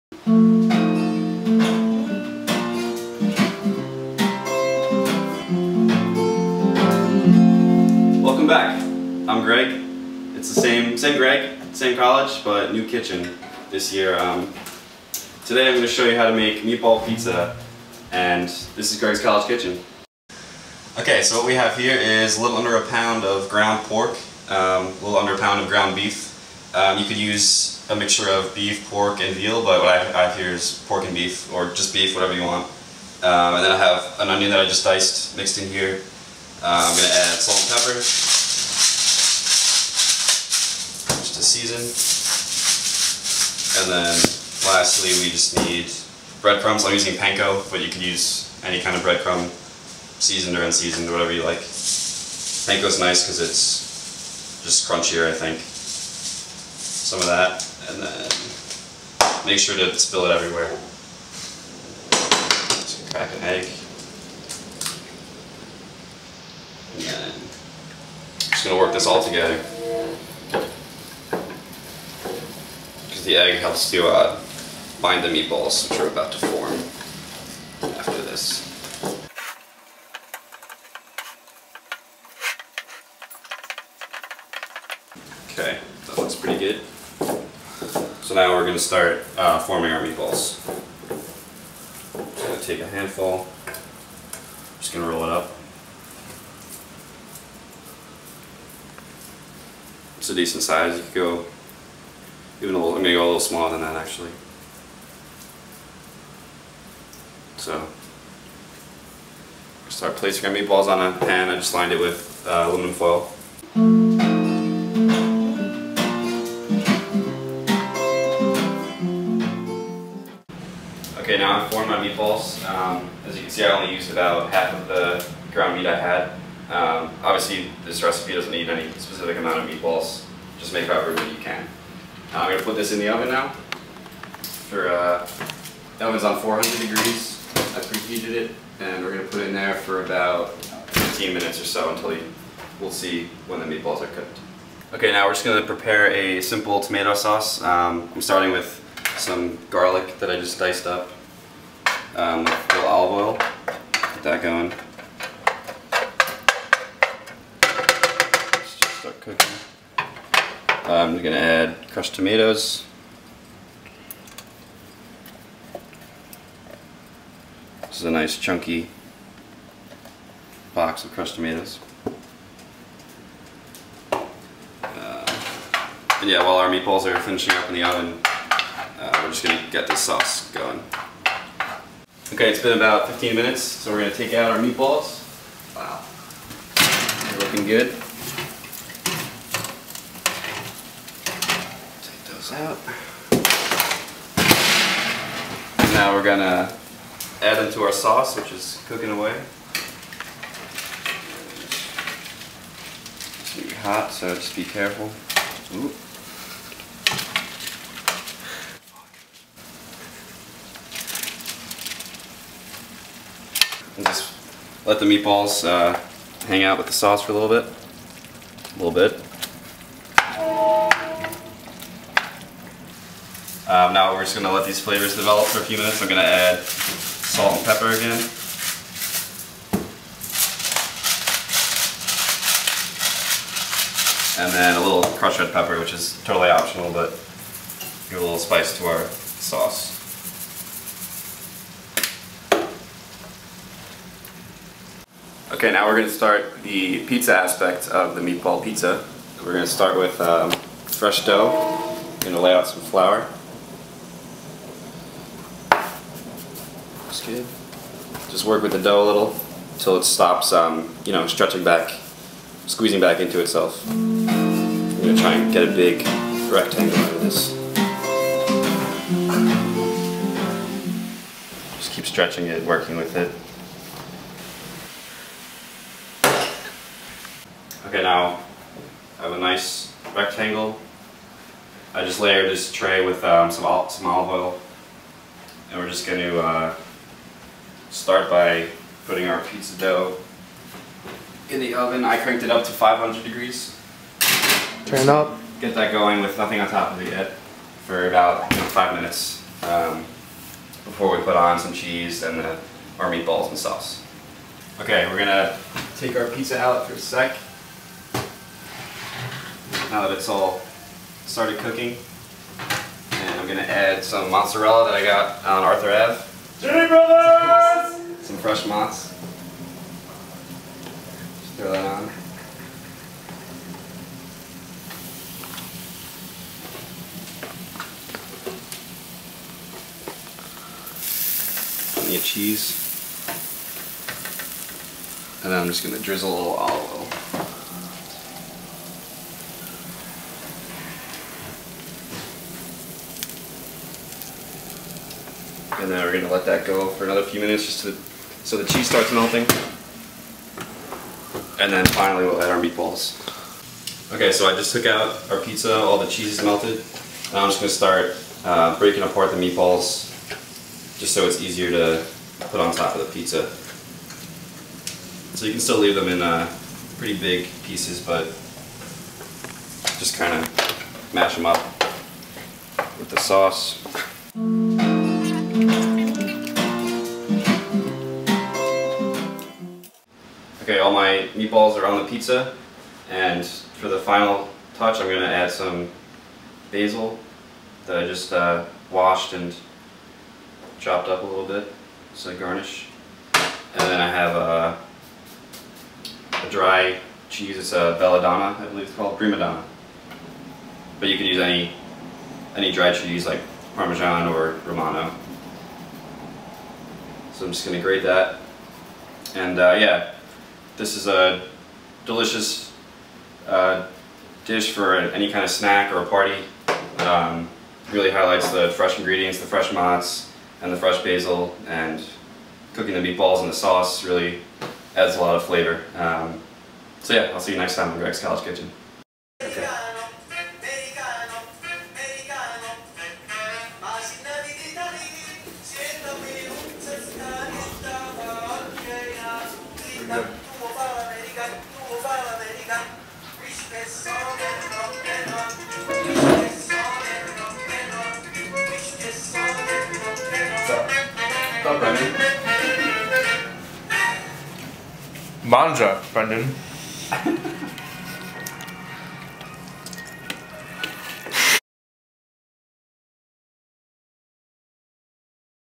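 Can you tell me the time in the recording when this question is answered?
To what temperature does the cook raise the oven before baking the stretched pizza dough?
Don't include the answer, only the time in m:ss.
4:52.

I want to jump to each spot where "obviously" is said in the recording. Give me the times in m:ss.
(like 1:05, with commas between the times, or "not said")
2:07.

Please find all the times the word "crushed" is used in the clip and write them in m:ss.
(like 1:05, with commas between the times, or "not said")
2:41, 2:51, 3:55.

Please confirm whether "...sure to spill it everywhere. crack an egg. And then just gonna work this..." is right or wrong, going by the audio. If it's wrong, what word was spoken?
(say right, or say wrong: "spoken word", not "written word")
right.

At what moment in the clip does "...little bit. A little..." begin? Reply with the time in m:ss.
3:37.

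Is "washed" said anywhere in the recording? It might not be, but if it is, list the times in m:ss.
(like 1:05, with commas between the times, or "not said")
6:28.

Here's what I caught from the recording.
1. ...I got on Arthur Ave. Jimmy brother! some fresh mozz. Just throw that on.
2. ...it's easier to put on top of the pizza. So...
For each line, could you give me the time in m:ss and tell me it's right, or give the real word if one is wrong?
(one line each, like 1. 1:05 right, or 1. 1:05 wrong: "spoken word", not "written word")
1. 5:14 right
2. 6:01 right.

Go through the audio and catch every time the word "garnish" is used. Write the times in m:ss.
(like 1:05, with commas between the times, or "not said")
6:32.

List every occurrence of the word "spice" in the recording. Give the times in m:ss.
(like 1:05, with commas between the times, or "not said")
3:58.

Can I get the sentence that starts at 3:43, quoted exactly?
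Um, now we're just going to let these flavors develop for a few minutes.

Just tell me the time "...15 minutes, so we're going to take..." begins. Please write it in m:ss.
3:03.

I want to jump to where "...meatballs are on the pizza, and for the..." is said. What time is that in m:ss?
6:21.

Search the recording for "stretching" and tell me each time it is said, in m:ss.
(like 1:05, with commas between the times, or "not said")
4:21, 4:32.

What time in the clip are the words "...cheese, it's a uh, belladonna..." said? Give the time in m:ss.
6:37.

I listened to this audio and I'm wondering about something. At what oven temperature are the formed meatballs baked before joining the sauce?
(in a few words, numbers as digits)
400 degrees.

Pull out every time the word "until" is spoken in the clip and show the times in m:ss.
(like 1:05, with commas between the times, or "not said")
2:21, 4:19.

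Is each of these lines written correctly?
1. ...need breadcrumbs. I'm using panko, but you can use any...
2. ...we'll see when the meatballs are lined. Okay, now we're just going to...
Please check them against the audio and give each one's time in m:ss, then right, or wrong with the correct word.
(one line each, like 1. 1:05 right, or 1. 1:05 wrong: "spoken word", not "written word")
1. 0:45 right
2. 2:22 wrong: "cooked", not "lined".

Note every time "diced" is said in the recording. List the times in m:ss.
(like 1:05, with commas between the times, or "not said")
0:34, 2:30.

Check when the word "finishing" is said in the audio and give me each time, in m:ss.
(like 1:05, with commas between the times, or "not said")
2:57.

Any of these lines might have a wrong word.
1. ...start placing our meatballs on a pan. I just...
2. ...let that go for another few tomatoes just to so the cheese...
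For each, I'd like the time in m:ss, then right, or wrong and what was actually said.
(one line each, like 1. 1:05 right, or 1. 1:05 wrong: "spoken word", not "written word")
1. 1:49 right
2. 5:46 wrong: "minutes", not "tomatoes".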